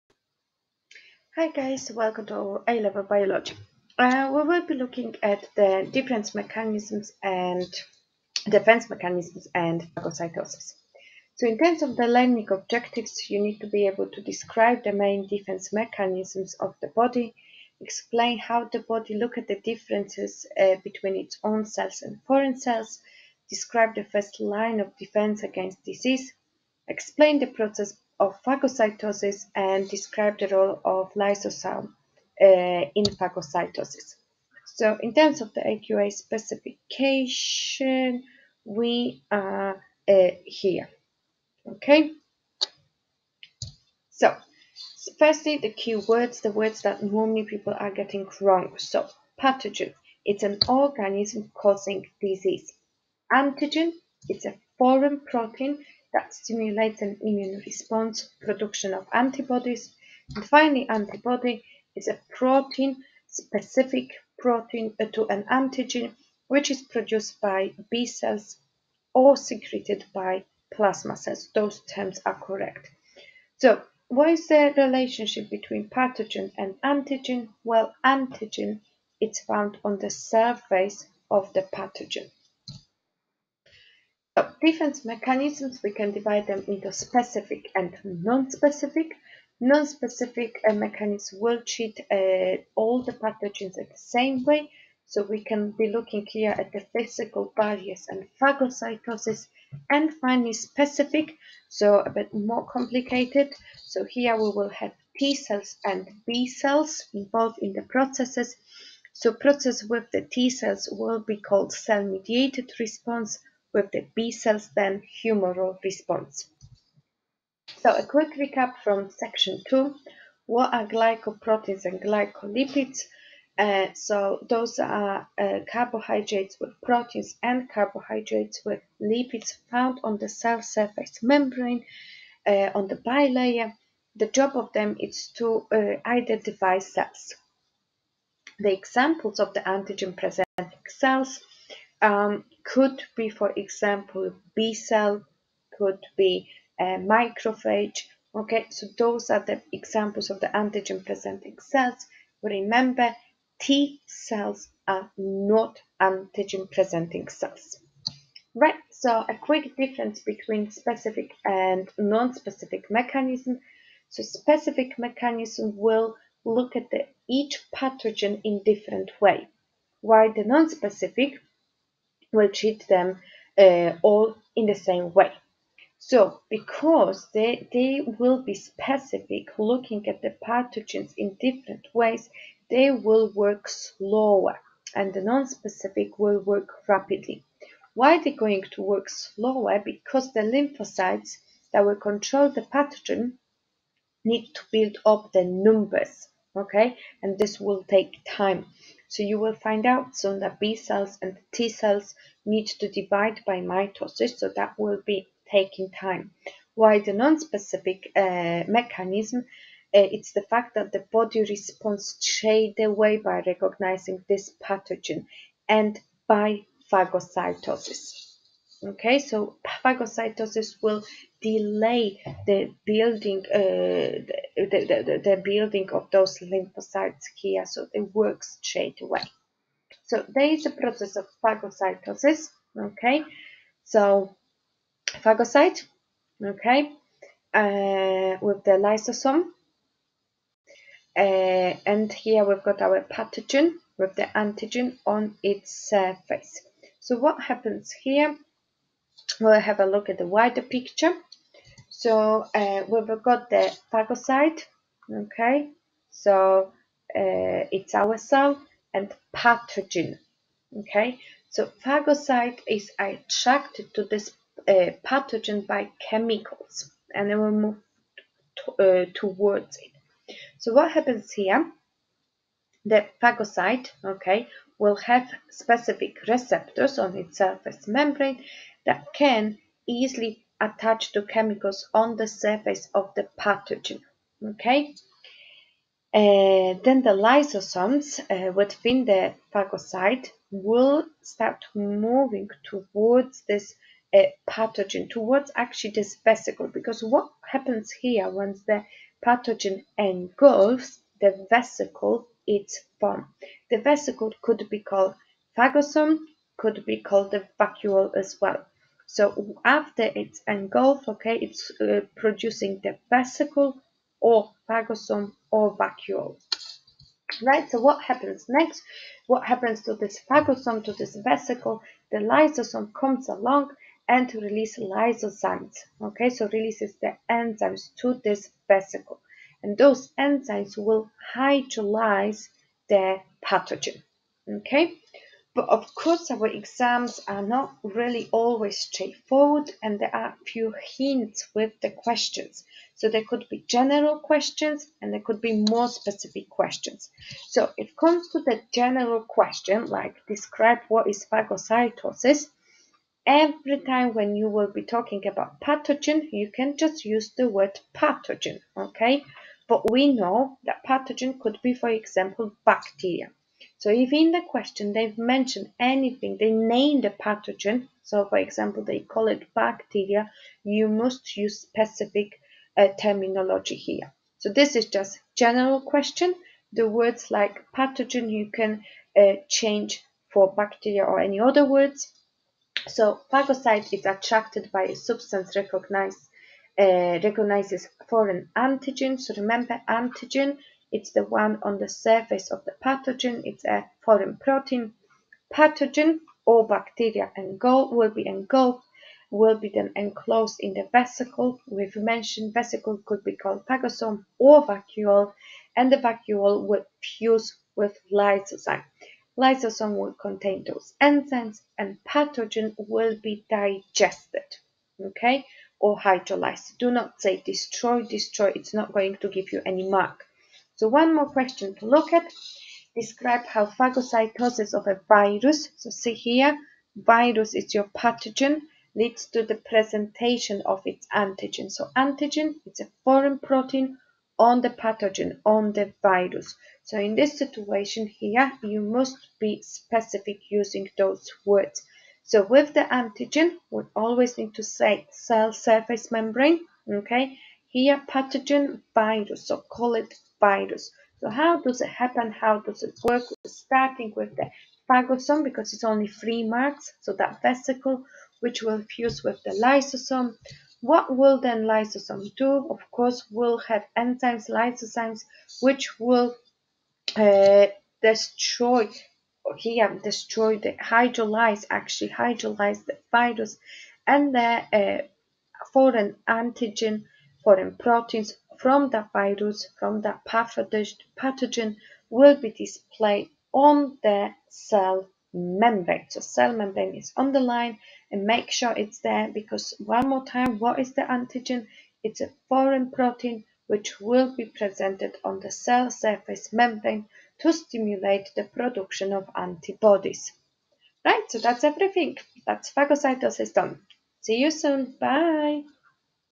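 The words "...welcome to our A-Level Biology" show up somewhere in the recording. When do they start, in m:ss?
0:01.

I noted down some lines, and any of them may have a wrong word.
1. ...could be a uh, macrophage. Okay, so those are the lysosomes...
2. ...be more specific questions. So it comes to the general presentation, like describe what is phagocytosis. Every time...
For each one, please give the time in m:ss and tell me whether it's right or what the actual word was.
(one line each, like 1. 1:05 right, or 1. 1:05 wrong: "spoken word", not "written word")
1. 2:25 wrong: "examples", not "lysosomes"
2. 5:45 wrong: "question", not "presentation".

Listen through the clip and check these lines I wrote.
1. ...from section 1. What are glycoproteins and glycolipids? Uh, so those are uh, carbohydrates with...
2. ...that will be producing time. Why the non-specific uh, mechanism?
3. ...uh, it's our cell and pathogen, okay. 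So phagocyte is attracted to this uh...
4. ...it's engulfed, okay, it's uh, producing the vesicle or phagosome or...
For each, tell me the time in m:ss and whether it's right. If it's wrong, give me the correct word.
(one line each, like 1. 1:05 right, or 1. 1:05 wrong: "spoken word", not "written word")
1. 1:58 wrong: "2", not "1"
2. 3:24 wrong: "taking", not "producing"
3. 4:17 right
4. 5:10 right.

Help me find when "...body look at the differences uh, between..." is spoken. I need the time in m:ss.
0:18.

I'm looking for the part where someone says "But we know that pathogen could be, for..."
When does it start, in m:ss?
5:59.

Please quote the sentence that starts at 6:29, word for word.
So remember antigen it's the one on the surface of the pathogen.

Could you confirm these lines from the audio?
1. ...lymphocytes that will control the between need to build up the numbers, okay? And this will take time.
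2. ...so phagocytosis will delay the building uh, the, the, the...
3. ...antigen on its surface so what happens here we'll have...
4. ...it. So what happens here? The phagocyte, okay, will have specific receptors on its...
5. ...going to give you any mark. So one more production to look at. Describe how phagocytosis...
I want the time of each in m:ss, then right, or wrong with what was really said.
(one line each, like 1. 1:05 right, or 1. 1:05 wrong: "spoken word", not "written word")
1. 3:10 wrong: "pathogen", not "between"
2. 3:39 right
3. 4:04 right
4. 4:29 right
5. 6:58 wrong: "question", not "production".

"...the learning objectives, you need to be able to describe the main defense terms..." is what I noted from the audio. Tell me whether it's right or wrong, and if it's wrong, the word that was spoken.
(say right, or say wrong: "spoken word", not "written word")
wrong: "mechanisms", not "terms".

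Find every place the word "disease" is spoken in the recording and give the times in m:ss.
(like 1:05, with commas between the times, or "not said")
0:25, 0:52.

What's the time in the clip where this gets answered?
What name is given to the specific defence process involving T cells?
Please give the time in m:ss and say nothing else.
1:51.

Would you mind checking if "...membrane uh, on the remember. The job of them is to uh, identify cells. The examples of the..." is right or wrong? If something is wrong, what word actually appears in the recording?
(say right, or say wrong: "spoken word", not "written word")
wrong: "bilayer", not "remember".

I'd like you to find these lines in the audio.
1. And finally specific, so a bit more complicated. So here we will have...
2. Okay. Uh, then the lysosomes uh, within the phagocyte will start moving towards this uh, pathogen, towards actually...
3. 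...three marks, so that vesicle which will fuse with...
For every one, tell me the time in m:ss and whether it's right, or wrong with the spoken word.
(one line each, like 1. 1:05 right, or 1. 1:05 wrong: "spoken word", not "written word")
1. 1:39 right
2. 4:44 right
3. 7:36 right.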